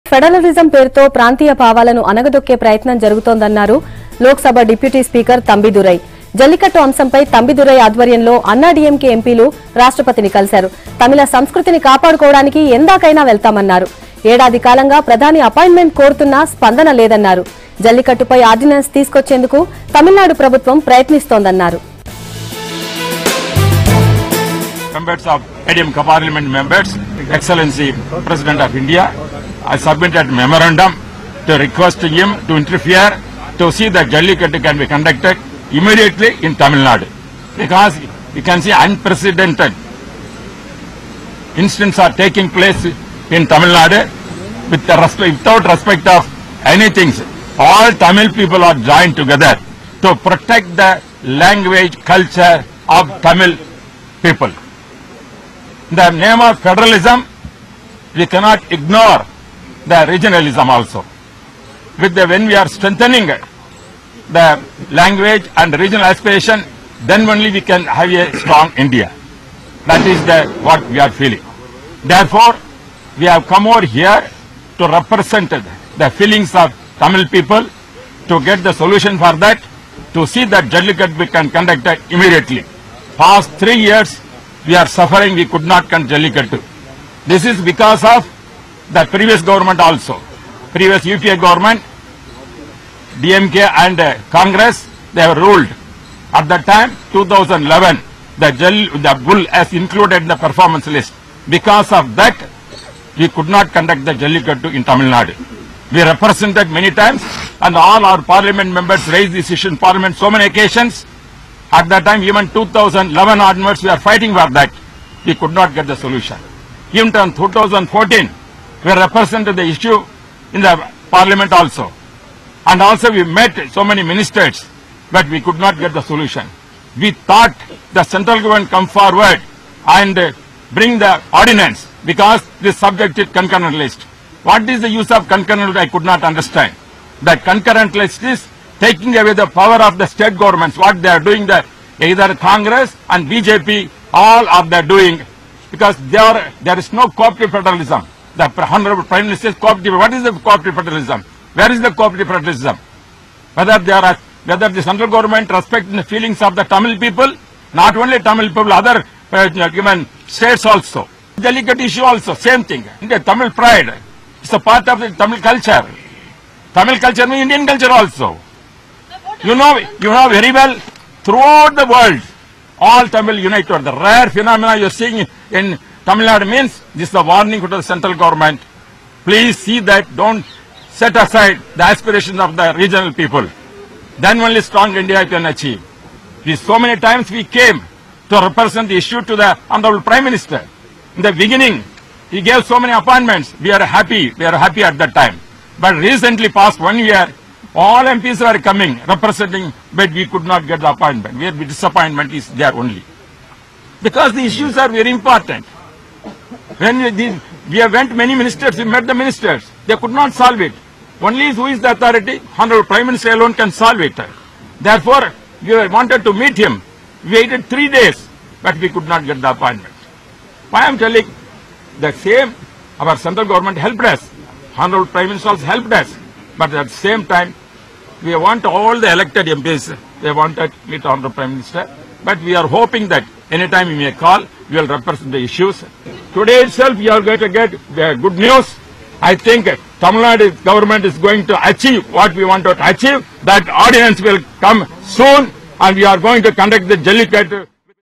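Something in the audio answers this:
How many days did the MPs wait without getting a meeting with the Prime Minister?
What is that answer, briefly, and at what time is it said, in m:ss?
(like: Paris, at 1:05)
3, at 3:37.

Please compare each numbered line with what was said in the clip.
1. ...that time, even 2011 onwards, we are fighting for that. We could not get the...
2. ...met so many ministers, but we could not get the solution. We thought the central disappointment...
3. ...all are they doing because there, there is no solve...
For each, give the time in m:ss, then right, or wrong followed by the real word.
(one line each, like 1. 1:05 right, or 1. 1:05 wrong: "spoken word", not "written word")
1. 1:51 right
2. 2:03 wrong: "government", not "disappointment"
3. 2:24 wrong: "cooperative", not "solve".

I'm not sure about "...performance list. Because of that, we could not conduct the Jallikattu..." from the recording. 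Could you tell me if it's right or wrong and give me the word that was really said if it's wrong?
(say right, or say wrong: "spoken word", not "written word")
right.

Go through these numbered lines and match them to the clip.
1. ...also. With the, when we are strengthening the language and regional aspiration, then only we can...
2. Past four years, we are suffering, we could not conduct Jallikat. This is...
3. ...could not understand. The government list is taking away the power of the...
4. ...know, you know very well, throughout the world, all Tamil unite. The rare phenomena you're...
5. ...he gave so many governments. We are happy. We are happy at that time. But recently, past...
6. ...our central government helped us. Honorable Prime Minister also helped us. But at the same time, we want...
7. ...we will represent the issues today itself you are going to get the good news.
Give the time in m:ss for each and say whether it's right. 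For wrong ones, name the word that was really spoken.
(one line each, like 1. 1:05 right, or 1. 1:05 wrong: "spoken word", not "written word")
1. 1:00 right
2. 1:23 wrong: "three", not "four"
3. 2:15 wrong: "concurrent", not "government"
4. 2:49 right
5. 3:12 wrong: "appointments", not "governments"
6. 3:42 right
7. 3:54 right.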